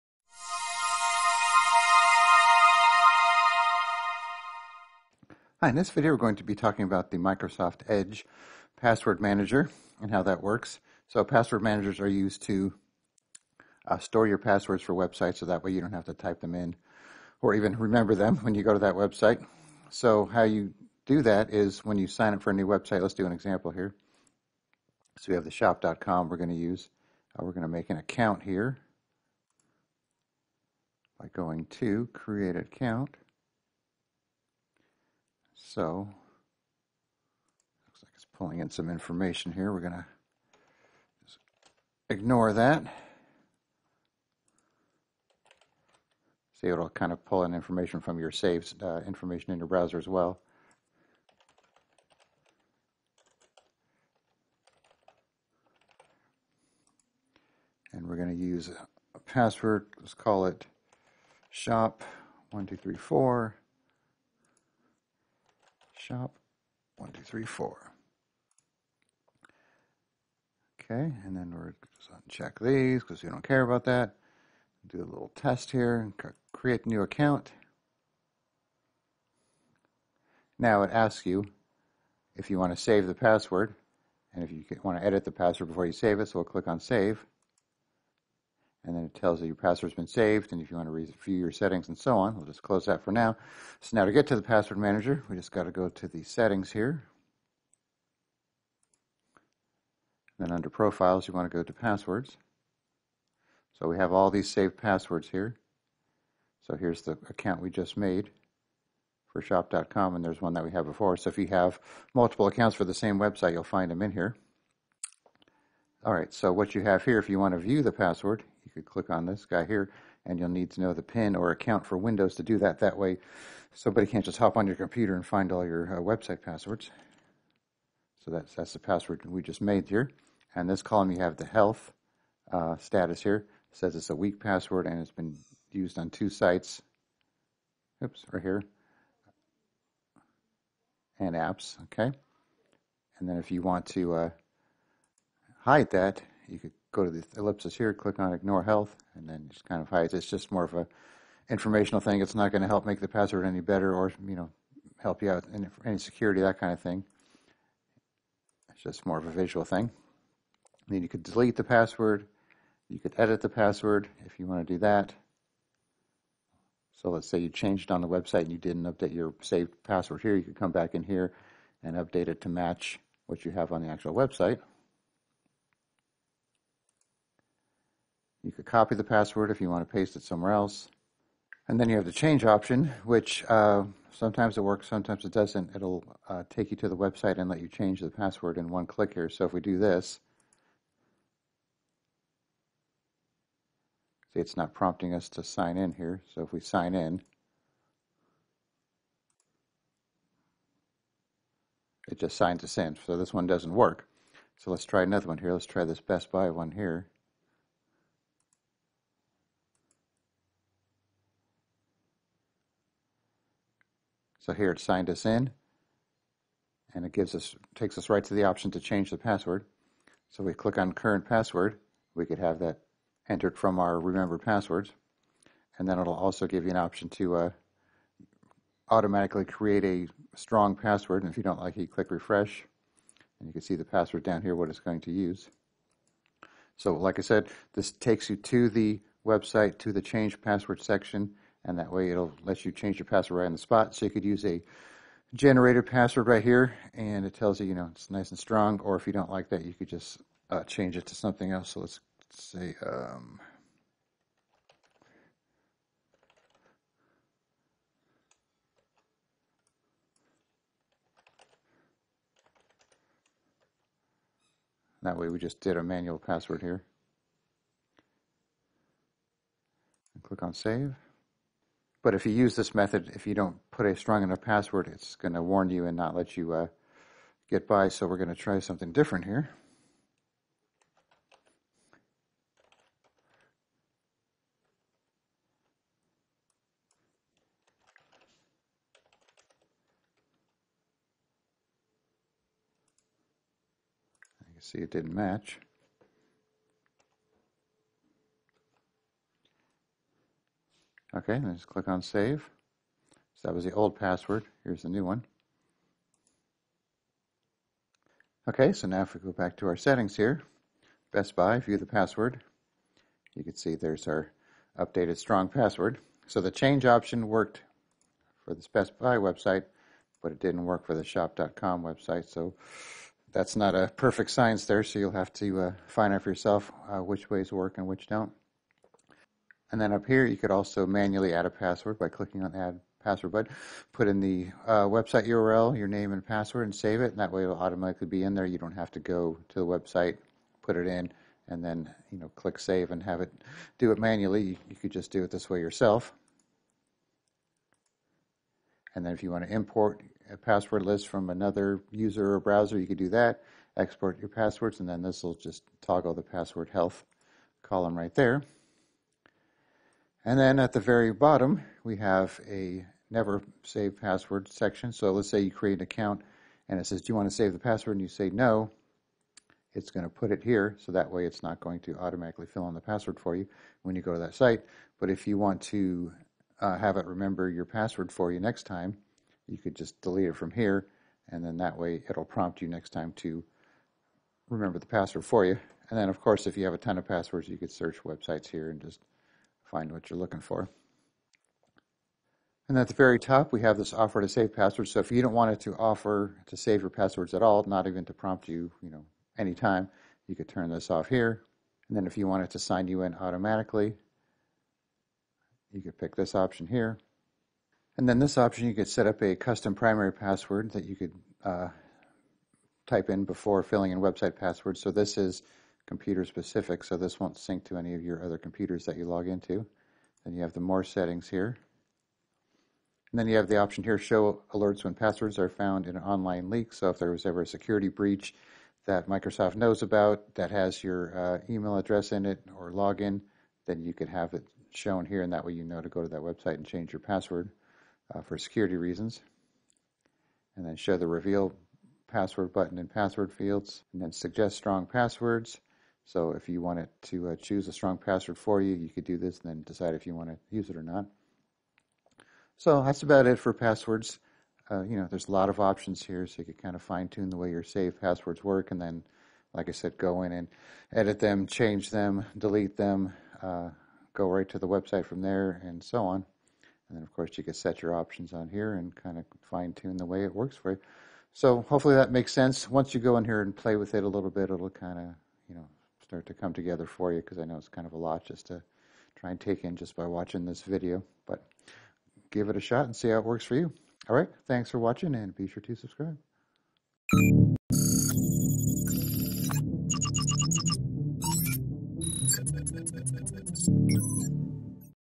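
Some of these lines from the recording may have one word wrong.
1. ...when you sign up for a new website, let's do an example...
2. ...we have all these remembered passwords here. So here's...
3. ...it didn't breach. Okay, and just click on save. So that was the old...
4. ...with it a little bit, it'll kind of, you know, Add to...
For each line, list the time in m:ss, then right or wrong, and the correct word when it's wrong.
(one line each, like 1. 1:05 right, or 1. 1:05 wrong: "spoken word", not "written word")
1. 0:21 right
2. 1:43 wrong: "saved", not "remembered"
3. 4:54 wrong: "match", not "breach"
4. 7:53 wrong: "Start", not "Add".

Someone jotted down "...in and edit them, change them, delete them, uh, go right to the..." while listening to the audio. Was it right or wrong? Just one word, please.
right.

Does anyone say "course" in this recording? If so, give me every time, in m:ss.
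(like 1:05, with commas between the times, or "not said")
6:26, 7:47.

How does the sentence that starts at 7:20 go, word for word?
And then show the reveal password button in password fields, and then suggest strong passwords.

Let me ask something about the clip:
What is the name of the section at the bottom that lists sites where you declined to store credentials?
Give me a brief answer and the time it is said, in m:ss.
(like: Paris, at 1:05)
never save password, at 6:03.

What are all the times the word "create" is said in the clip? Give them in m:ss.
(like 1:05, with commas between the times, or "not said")
0:32, 1:16, 3:49, 6:05.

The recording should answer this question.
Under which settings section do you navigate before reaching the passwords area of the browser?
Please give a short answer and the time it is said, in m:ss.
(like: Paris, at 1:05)
profiles, at 1:40.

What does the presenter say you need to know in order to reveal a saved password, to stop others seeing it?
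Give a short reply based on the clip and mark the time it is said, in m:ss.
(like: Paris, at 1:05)
PIN, at 2:01.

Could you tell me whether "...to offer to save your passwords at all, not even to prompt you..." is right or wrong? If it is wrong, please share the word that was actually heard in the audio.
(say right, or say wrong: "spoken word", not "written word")
right.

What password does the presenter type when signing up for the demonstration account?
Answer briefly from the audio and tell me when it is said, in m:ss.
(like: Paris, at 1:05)
shop1234, at 1:01.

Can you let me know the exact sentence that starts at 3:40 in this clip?
So we click on current password.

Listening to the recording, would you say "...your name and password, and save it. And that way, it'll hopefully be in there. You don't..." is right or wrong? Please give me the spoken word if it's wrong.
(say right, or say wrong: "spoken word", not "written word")
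wrong: "automatically", not "hopefully".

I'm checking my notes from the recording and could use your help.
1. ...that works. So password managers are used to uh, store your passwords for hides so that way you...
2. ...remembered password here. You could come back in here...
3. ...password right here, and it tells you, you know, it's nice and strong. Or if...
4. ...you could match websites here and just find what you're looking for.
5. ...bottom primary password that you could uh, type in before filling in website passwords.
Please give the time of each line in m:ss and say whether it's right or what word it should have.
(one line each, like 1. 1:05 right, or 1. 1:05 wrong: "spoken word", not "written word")
1. 0:10 wrong: "websites", not "hides"
2. 2:49 wrong: "saved", not "remembered"
3. 4:05 right
4. 6:27 wrong: "search", not "match"
5. 6:49 wrong: "custom", not "bottom".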